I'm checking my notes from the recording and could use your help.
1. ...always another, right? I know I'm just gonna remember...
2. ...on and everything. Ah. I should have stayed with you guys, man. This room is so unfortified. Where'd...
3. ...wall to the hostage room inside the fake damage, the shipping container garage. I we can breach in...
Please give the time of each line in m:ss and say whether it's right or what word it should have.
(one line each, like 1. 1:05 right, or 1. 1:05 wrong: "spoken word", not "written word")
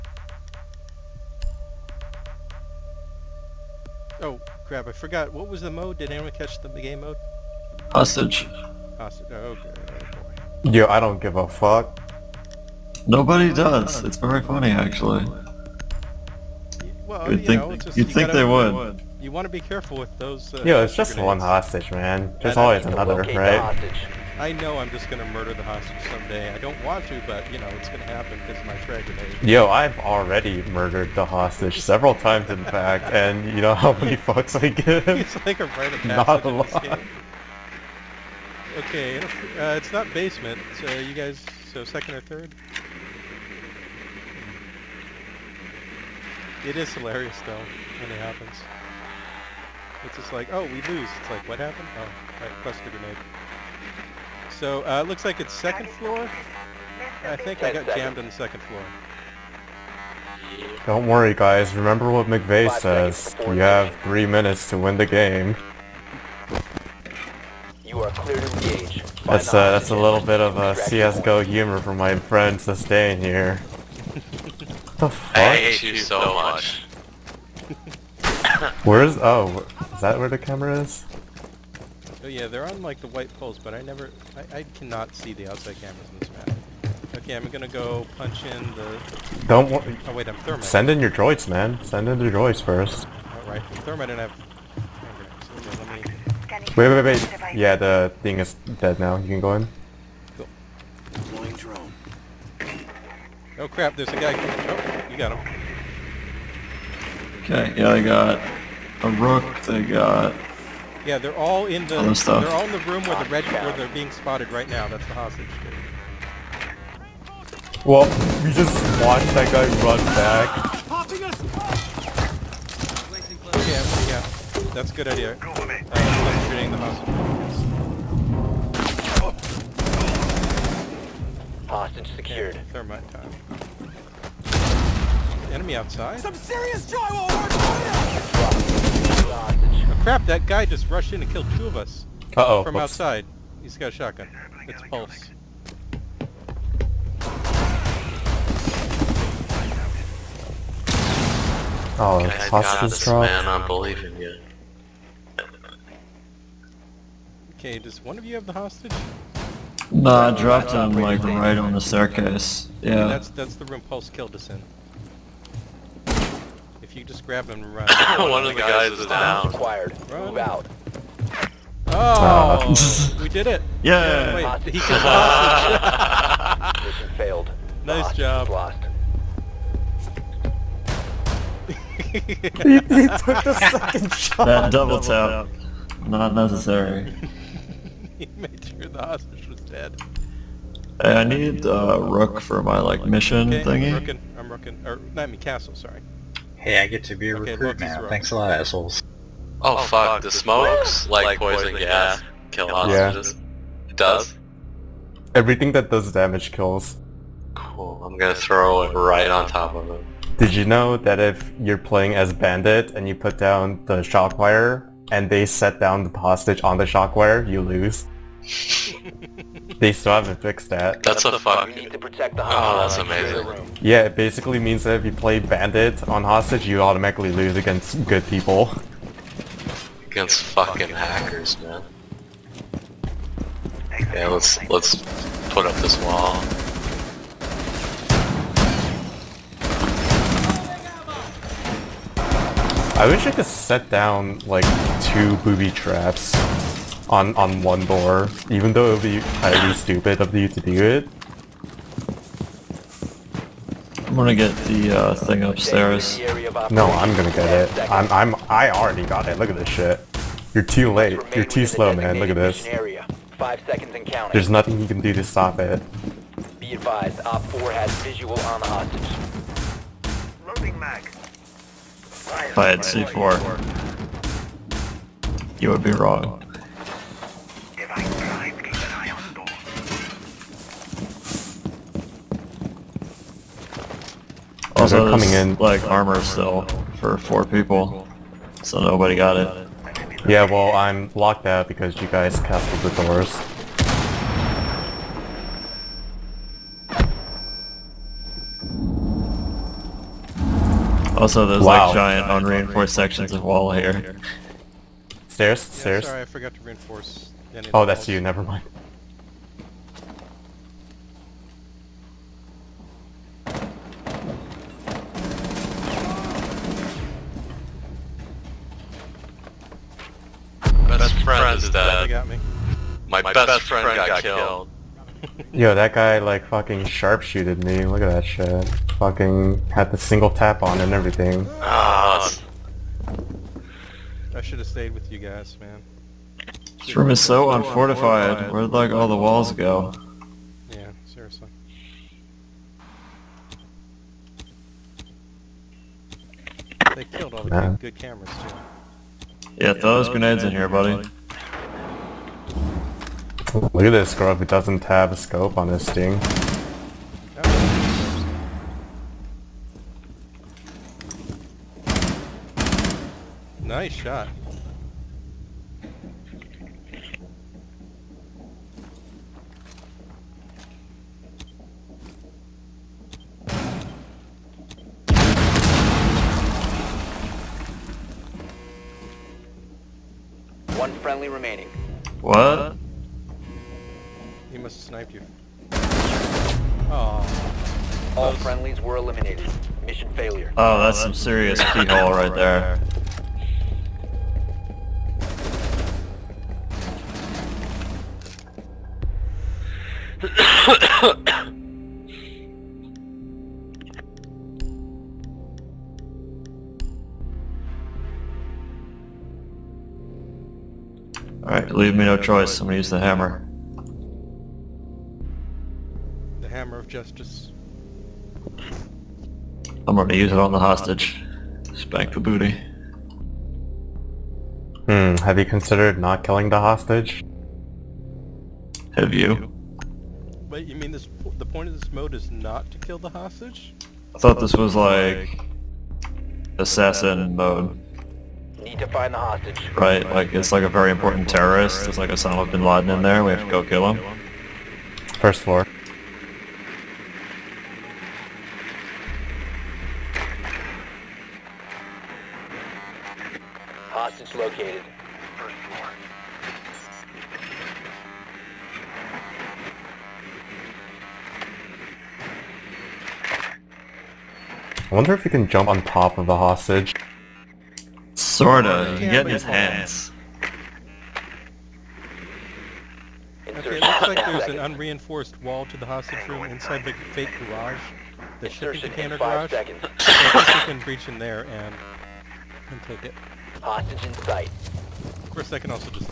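1. 0:22 wrong: "murder", not "remember"
2. 5:30 right
3. 7:55 wrong: "garage", not "damage".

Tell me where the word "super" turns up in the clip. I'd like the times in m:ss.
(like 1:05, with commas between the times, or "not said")
not said.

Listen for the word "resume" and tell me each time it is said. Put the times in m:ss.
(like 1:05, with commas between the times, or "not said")
not said.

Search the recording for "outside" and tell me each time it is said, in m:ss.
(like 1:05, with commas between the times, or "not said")
1:25, 2:15, 2:22.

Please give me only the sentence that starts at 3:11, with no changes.
Hey, I need uh, Rook for my like mission okay, thingy.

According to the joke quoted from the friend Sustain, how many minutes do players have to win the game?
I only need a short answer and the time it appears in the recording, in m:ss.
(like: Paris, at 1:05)
3, at 1:04.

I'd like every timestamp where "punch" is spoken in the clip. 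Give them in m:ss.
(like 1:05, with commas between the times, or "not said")
1:28.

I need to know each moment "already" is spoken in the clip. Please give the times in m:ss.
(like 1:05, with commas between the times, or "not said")
0:29, 4:18.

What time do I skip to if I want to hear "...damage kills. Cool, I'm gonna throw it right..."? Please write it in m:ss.
3:26.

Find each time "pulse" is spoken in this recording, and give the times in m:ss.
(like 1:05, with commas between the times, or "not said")
2:24, 2:43.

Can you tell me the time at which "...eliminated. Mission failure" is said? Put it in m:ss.
6:28.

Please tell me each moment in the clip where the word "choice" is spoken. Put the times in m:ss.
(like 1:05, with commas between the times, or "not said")
6:52.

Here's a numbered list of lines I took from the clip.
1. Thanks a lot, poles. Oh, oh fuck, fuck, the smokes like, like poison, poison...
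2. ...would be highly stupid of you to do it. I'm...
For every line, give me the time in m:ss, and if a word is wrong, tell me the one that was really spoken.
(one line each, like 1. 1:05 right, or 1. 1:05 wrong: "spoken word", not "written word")
1. 3:18 wrong: "assholes", not "poles"
2. 4:08 right.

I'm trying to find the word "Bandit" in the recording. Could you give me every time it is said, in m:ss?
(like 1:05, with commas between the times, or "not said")
3:32, 3:45.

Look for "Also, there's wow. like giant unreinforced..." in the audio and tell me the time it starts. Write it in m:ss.
5:01.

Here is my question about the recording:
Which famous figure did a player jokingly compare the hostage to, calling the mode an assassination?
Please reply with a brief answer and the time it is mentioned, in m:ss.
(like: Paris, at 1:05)
bin Laden, at 7:22.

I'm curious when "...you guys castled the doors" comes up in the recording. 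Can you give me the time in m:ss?
4:52.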